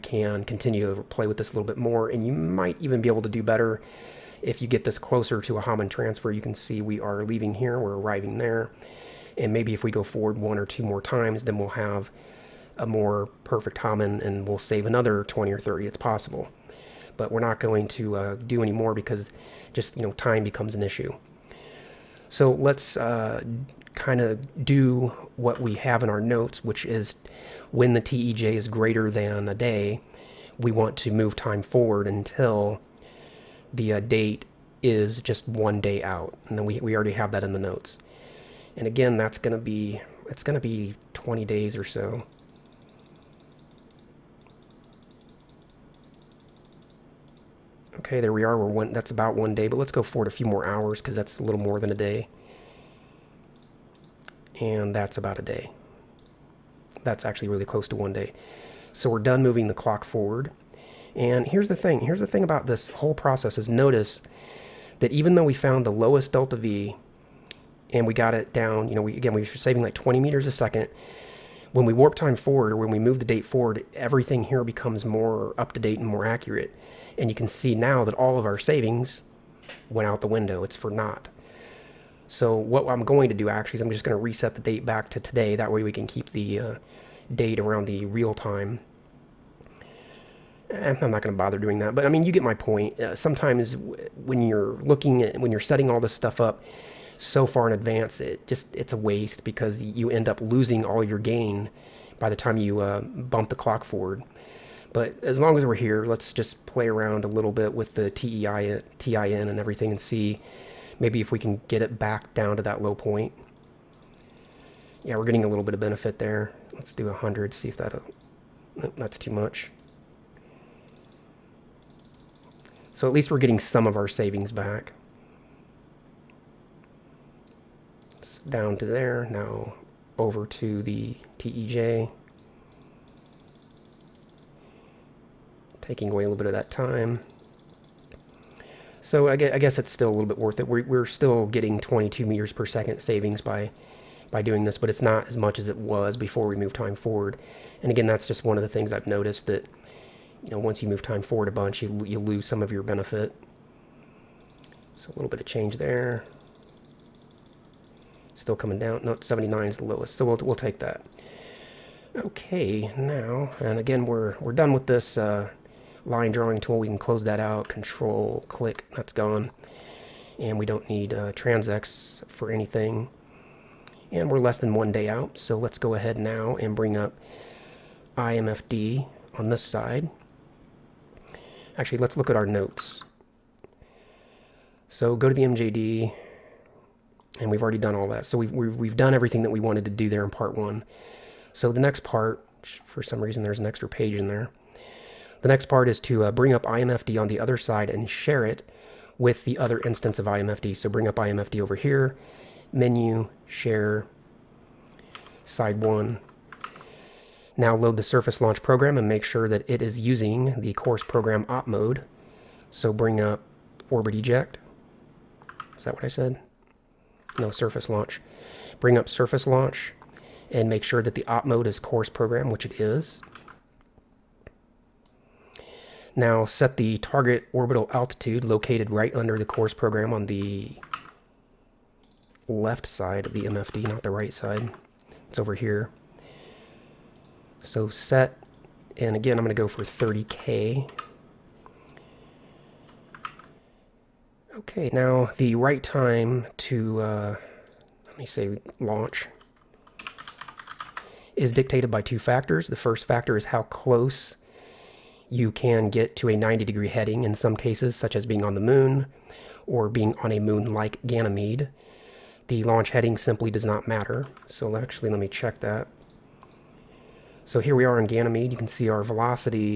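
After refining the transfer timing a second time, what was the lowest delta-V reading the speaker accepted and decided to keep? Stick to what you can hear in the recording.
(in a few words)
79.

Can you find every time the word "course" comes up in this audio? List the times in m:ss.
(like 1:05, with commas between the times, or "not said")
3:30, 3:41, 3:49.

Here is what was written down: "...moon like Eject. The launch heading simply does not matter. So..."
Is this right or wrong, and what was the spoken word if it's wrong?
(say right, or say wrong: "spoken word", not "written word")
wrong: "Ganymede", not "Eject".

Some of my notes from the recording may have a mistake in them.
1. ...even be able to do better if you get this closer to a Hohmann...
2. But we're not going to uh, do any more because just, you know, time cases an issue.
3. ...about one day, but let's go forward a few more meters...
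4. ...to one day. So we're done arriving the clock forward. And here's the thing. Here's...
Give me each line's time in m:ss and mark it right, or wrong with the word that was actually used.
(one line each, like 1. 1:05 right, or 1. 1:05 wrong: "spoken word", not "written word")
1. 0:02 right
2. 0:17 wrong: "becomes", not "cases"
3. 0:49 wrong: "hours", not "meters"
4. 0:57 wrong: "moving", not "arriving".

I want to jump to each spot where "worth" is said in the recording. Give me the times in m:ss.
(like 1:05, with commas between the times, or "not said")
2:20.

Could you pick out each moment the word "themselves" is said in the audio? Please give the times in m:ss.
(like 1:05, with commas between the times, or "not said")
not said.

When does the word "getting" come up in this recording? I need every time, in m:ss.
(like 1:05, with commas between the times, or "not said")
1:55, 2:03, 2:21.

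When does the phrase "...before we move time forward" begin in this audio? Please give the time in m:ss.
2:26.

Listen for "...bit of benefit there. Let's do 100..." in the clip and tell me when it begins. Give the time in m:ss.
1:55.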